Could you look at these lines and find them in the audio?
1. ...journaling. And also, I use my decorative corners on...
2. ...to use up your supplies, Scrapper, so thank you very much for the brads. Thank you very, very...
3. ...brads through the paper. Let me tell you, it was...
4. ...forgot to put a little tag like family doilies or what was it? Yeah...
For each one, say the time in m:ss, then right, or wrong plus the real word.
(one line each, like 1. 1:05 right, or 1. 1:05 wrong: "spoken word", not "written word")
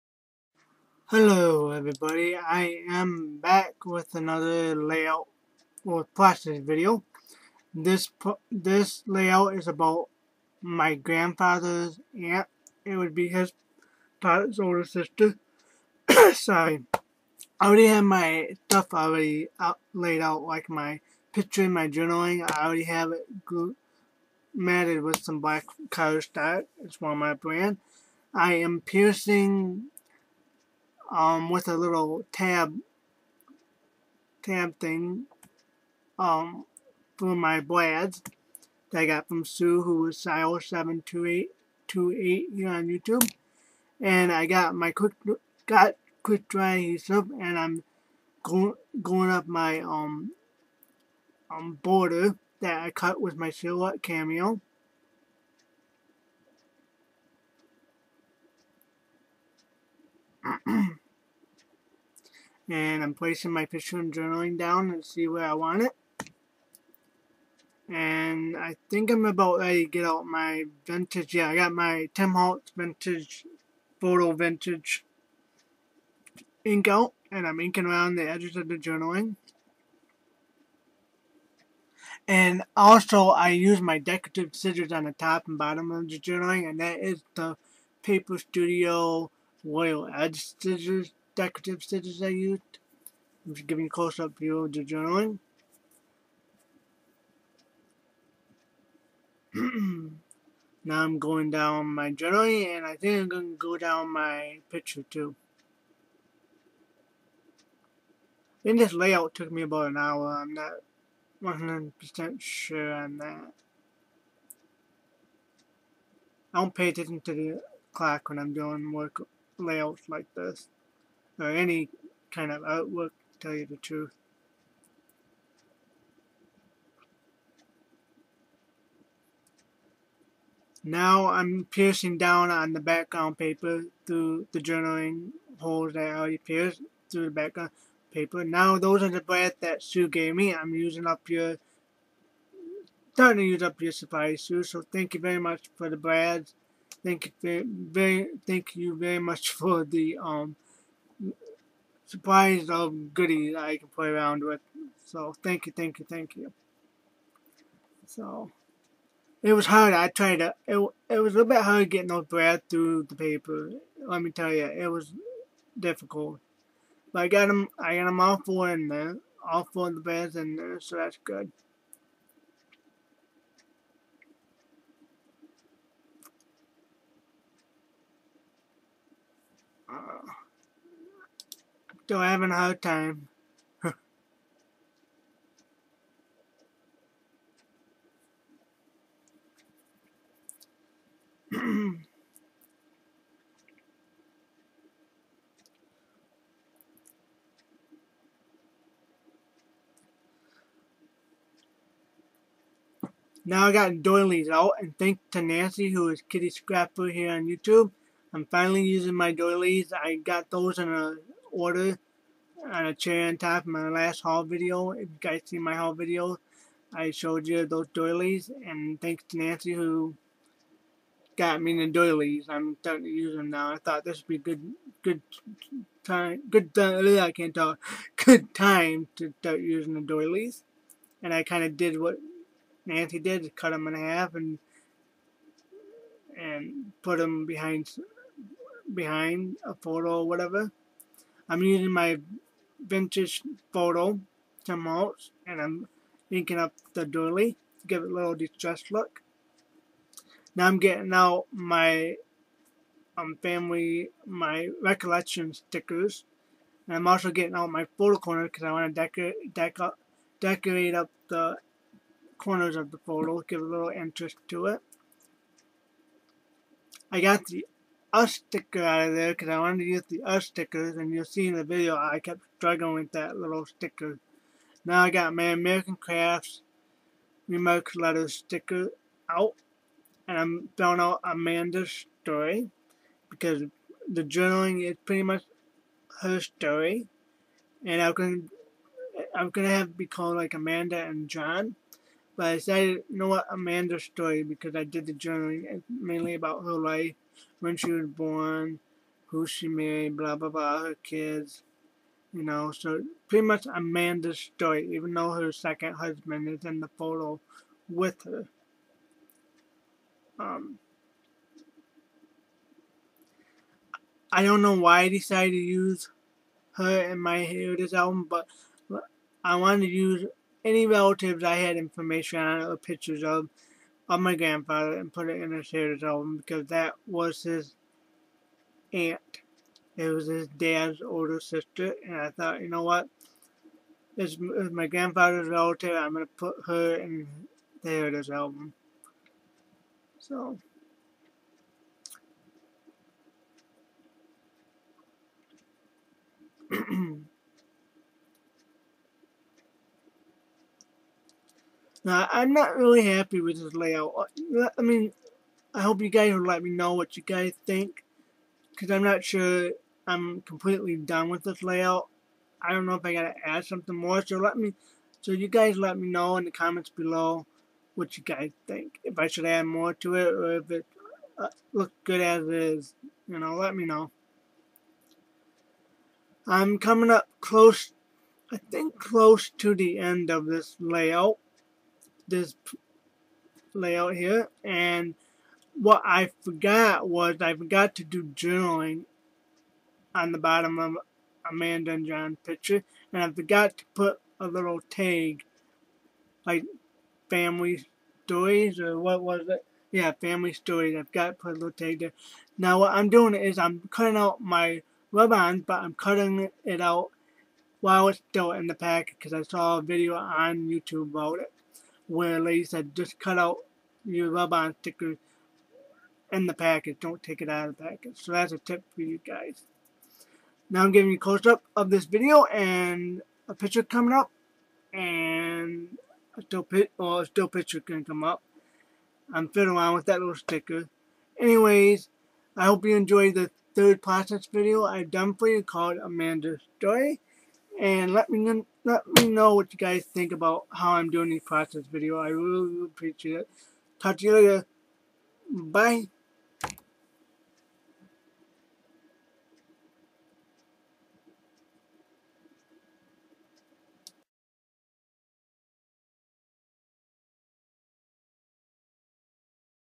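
1. 1:18 wrong: "scissors", not "corners"
2. 2:23 wrong: "Sue", not "Scrapper"
3. 2:42 right
4. 6:33 wrong: "stories", not "doilies".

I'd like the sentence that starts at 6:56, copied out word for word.
Don't take it out of the package.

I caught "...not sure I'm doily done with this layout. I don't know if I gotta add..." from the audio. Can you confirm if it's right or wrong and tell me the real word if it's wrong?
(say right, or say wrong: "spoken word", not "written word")
wrong: "completely", not "doily".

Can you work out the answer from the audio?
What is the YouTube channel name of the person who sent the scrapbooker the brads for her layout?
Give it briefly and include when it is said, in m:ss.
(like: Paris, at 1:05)
Sile72828, at 0:40.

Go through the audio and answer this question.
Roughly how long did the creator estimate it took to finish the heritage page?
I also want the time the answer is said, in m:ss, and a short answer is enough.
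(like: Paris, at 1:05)
about an hour, at 1:49.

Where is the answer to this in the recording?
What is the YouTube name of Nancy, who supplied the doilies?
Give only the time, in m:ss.
3:26.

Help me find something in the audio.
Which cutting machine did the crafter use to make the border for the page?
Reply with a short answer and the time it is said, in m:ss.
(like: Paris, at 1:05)
Silhouette Cameo, at 0:53.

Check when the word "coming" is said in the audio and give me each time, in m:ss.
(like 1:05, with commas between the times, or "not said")
6:16, 7:03.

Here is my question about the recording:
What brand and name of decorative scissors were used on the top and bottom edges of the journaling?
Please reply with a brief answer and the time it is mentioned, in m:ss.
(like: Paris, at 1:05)
Paper Studio Royal Edge, at 1:28.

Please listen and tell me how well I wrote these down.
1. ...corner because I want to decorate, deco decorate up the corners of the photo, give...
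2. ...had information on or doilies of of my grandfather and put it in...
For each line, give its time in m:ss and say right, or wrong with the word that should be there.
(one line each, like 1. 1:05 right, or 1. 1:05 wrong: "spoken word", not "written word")
1. 4:18 right
2. 5:21 wrong: "pictures", not "doilies".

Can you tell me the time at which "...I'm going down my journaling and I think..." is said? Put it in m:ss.
1:41.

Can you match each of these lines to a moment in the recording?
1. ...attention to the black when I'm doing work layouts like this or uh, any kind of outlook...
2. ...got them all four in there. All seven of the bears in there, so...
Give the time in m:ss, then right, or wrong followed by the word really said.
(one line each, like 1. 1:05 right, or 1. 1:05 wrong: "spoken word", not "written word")
1. 1:56 wrong: "clock", not "black"
2. 2:47 wrong: "four", not "seven".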